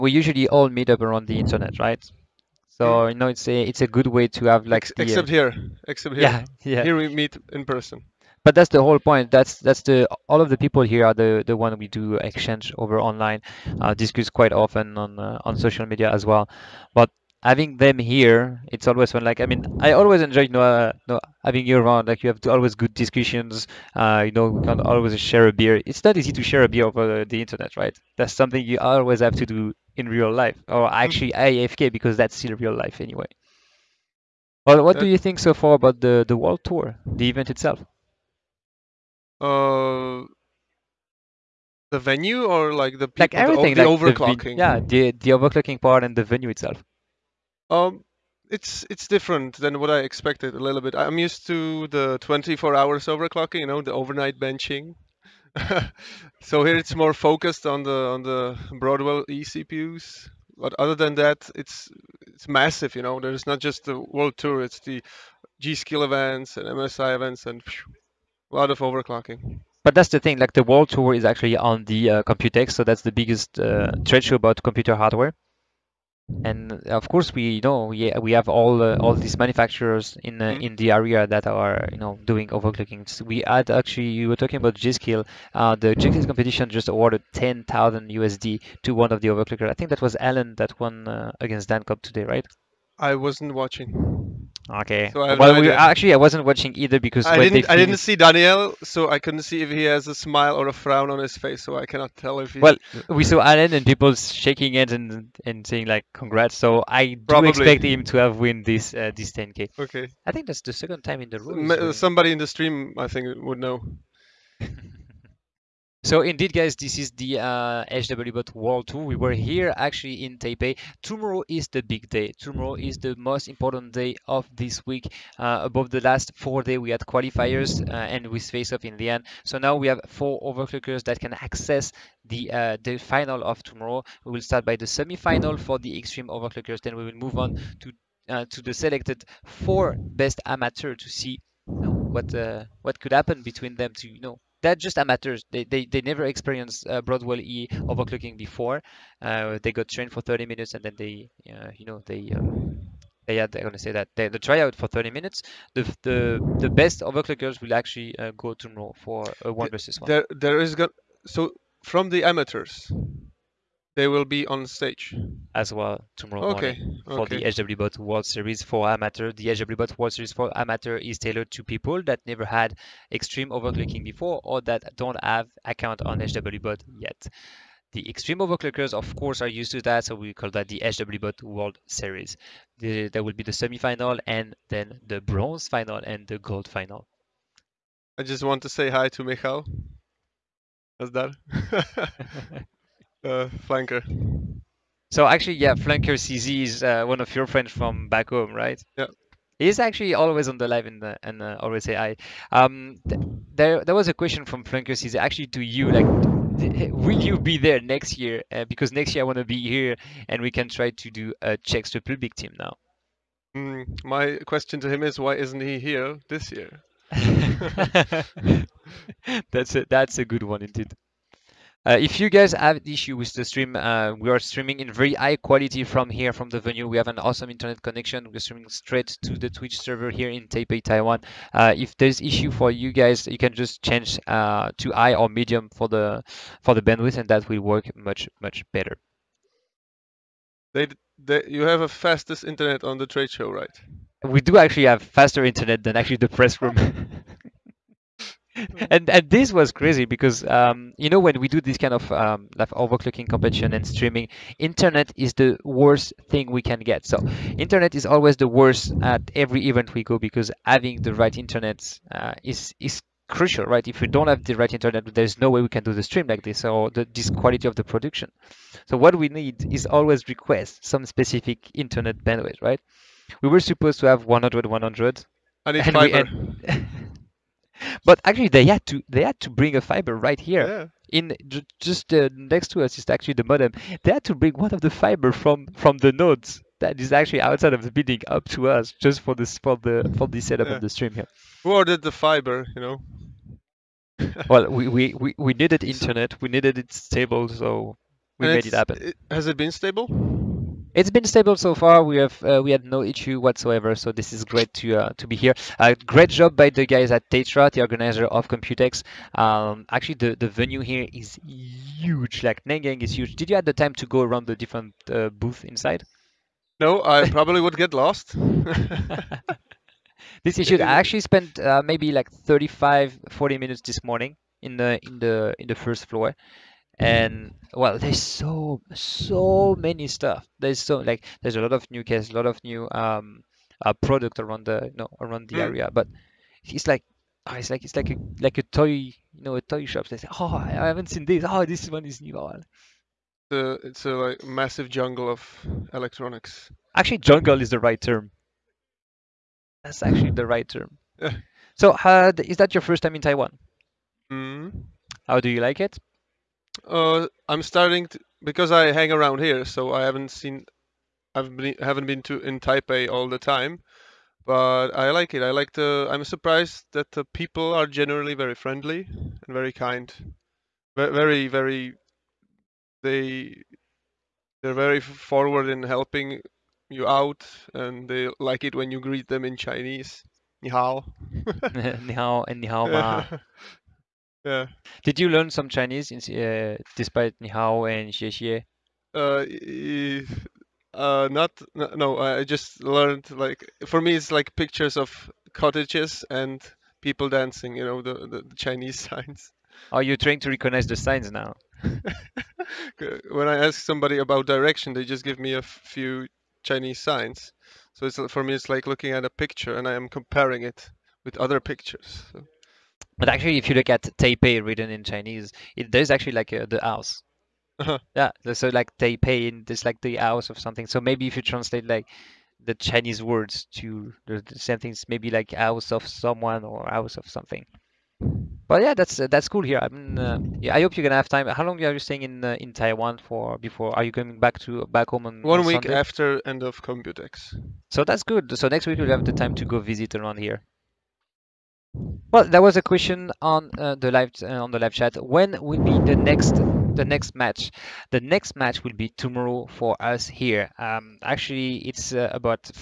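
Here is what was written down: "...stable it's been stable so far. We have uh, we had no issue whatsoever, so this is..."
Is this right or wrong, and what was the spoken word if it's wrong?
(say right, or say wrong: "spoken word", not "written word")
right.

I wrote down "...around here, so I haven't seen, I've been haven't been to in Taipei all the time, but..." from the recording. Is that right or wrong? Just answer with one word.
right.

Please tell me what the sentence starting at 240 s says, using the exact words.
They, they, you have a fastest internet on the trade show, right?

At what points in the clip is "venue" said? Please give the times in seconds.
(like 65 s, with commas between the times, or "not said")
41 s, 46 s, 226 s, 310 s.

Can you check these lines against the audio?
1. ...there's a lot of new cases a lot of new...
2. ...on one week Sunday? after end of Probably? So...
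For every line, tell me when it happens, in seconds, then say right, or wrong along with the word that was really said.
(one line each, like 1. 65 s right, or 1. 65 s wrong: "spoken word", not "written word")
1. 331 s right
2. 435 s wrong: "Computex", not "Probably".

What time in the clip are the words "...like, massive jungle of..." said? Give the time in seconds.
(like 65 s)
344 s.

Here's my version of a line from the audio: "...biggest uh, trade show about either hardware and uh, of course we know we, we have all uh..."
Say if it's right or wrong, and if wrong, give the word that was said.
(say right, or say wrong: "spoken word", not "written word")
wrong: "computer", not "either".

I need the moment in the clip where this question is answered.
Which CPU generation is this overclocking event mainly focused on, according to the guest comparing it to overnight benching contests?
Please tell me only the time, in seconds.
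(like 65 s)
58 s.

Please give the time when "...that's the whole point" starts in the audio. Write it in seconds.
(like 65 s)
8 s.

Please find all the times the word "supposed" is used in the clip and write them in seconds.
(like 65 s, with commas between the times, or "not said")
273 s.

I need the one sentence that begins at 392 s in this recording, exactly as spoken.
I just learned like for me it's like pictures of cottages and people dancing.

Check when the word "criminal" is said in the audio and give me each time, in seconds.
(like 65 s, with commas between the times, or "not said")
not said.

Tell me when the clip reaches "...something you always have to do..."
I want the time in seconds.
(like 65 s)
28 s.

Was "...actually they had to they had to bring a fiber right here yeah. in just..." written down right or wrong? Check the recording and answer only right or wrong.
right.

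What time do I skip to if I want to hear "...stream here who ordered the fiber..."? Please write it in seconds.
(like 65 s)
290 s.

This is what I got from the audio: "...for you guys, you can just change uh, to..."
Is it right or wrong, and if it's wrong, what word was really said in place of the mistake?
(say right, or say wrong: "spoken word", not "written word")
right.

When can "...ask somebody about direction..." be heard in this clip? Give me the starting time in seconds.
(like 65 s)
403 s.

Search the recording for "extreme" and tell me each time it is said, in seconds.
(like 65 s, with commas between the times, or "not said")
135 s, 173 s, 178 s.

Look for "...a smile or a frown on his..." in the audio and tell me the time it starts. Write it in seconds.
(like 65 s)
100 s.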